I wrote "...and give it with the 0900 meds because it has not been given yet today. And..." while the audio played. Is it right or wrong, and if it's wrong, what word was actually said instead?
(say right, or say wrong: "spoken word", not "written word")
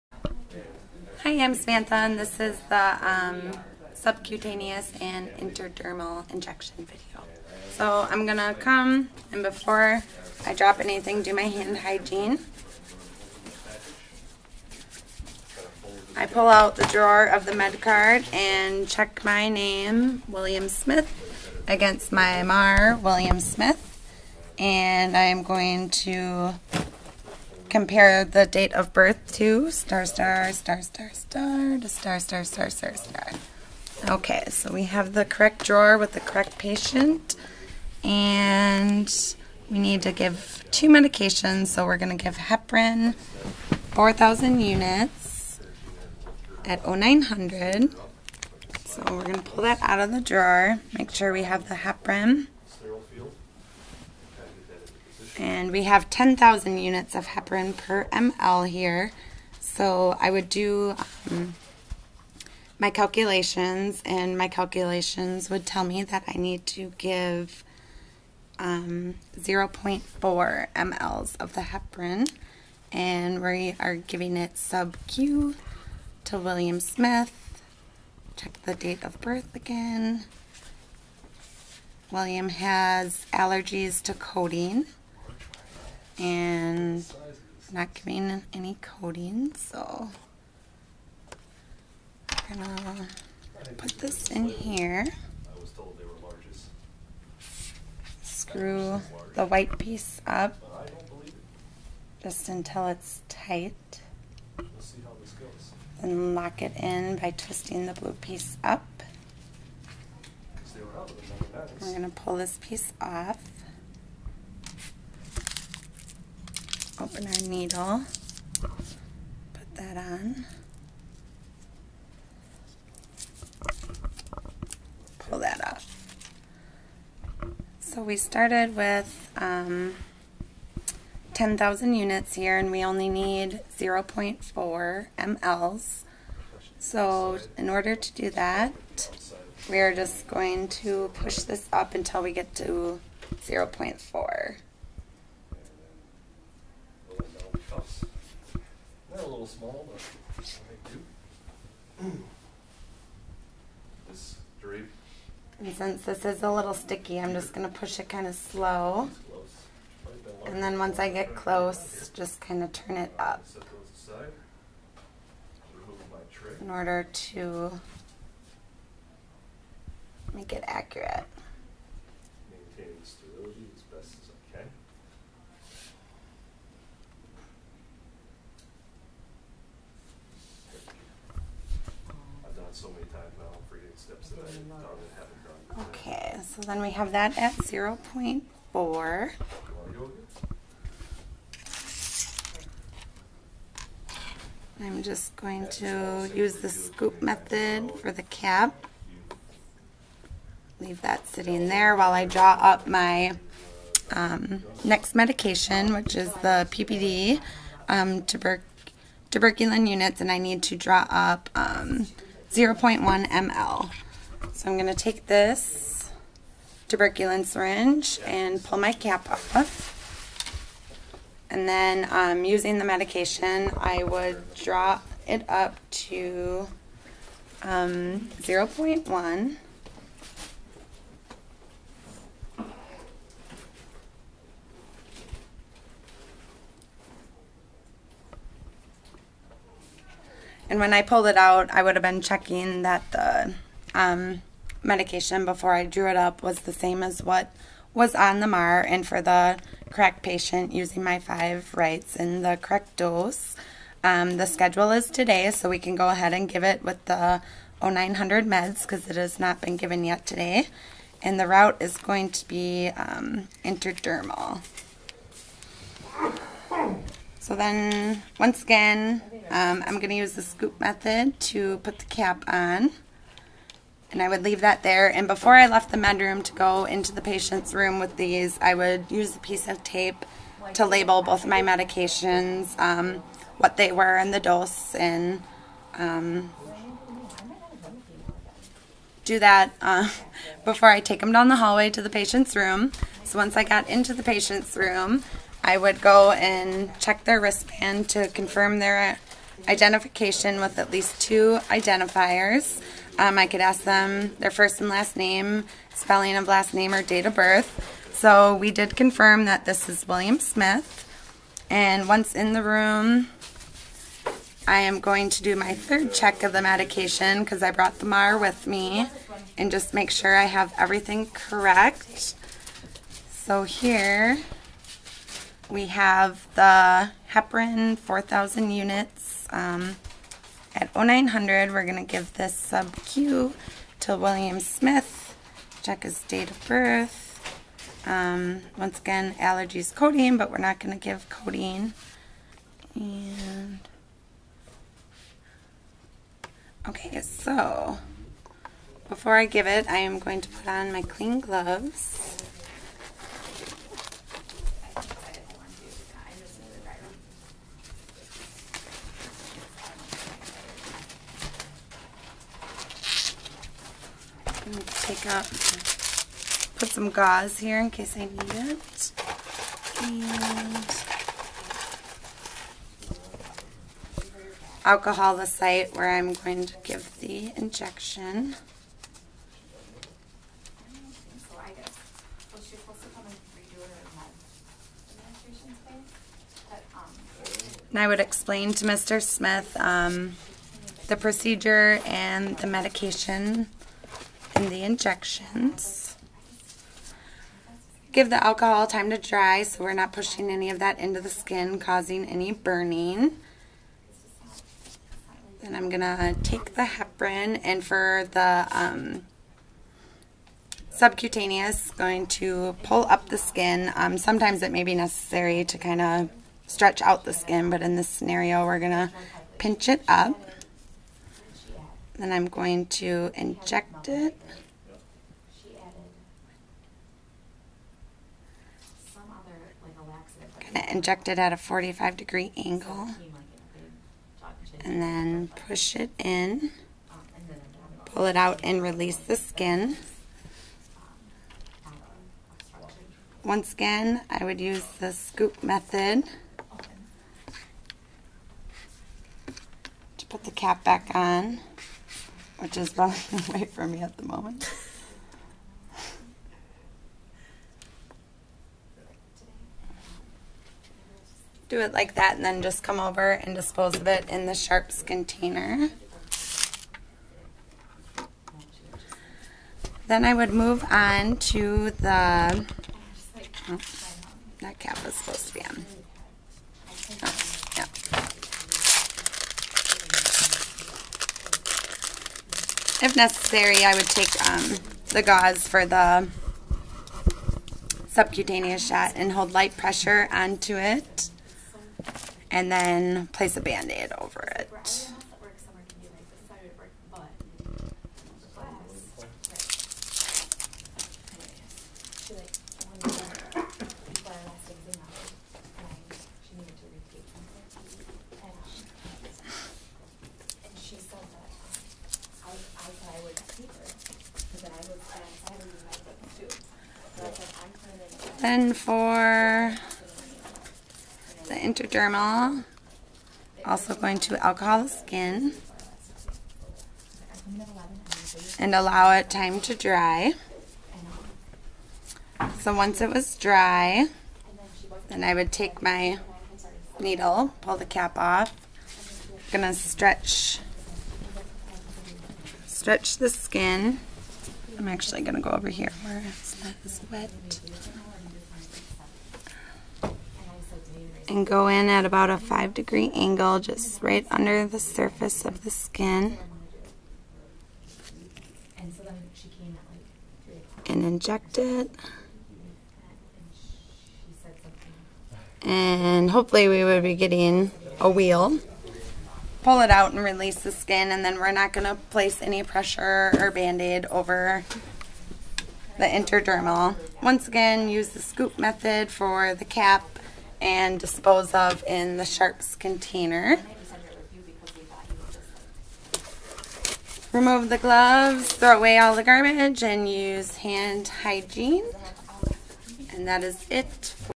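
right.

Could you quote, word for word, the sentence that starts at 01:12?
And we are giving it sub-Q to William Smith.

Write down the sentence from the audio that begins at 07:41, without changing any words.
Do it like that and then just come over and dispose of it in the Sharps container.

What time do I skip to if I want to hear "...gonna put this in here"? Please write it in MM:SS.
01:32.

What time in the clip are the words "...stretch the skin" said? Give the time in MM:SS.
09:02.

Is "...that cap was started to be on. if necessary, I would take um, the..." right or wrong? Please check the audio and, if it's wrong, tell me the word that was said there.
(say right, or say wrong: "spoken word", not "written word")
wrong: "supposed", not "started".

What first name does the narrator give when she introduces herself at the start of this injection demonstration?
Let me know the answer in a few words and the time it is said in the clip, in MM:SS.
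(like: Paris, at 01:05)
Samantha, at 00:01.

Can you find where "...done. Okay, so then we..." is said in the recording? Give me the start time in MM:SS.
03:05.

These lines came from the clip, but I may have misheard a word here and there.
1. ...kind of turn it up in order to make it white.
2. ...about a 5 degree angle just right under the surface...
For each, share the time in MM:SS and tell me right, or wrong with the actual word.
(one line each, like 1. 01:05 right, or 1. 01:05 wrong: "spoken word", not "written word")
1. 02:42 wrong: "accurate", not "white"
2. 09:12 right.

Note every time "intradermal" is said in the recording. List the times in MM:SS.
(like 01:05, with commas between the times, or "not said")
00:05, 04:23, 08:41, 09:36.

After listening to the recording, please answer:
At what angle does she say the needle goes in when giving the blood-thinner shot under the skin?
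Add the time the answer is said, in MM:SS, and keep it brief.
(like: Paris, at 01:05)
45 degrees, at 07:11.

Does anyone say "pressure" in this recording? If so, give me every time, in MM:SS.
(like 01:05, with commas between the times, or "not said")
08:09, 09:32.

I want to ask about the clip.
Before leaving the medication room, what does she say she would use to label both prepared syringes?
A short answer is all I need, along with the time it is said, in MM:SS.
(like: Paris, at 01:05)
A piece of tape, at 04:39.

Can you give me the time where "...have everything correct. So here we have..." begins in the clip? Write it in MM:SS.
05:20.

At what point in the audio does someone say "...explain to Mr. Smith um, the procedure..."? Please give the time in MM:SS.
06:28.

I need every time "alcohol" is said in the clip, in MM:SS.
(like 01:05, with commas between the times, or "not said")
06:14, 06:38, 08:44.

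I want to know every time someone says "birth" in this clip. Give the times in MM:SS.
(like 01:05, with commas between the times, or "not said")
00:28, 01:19, 05:07, 05:36.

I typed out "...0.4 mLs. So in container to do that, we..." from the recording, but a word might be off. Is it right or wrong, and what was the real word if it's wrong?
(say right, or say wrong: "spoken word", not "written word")
wrong: "order", not "container".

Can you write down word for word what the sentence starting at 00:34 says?
Okay, so we have the correct drawer with the correct patient, and we need to give two medications.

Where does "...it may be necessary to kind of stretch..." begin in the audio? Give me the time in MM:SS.
06:54.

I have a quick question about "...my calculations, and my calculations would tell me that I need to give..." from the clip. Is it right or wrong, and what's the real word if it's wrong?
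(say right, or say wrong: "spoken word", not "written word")
right.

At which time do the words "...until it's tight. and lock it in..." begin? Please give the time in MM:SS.
01:42.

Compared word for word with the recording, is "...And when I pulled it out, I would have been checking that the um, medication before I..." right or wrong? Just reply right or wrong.
right.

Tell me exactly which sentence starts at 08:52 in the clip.
So once it was dry, then I would take my needle, pull the cap off.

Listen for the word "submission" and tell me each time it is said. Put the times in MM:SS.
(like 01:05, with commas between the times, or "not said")
not said.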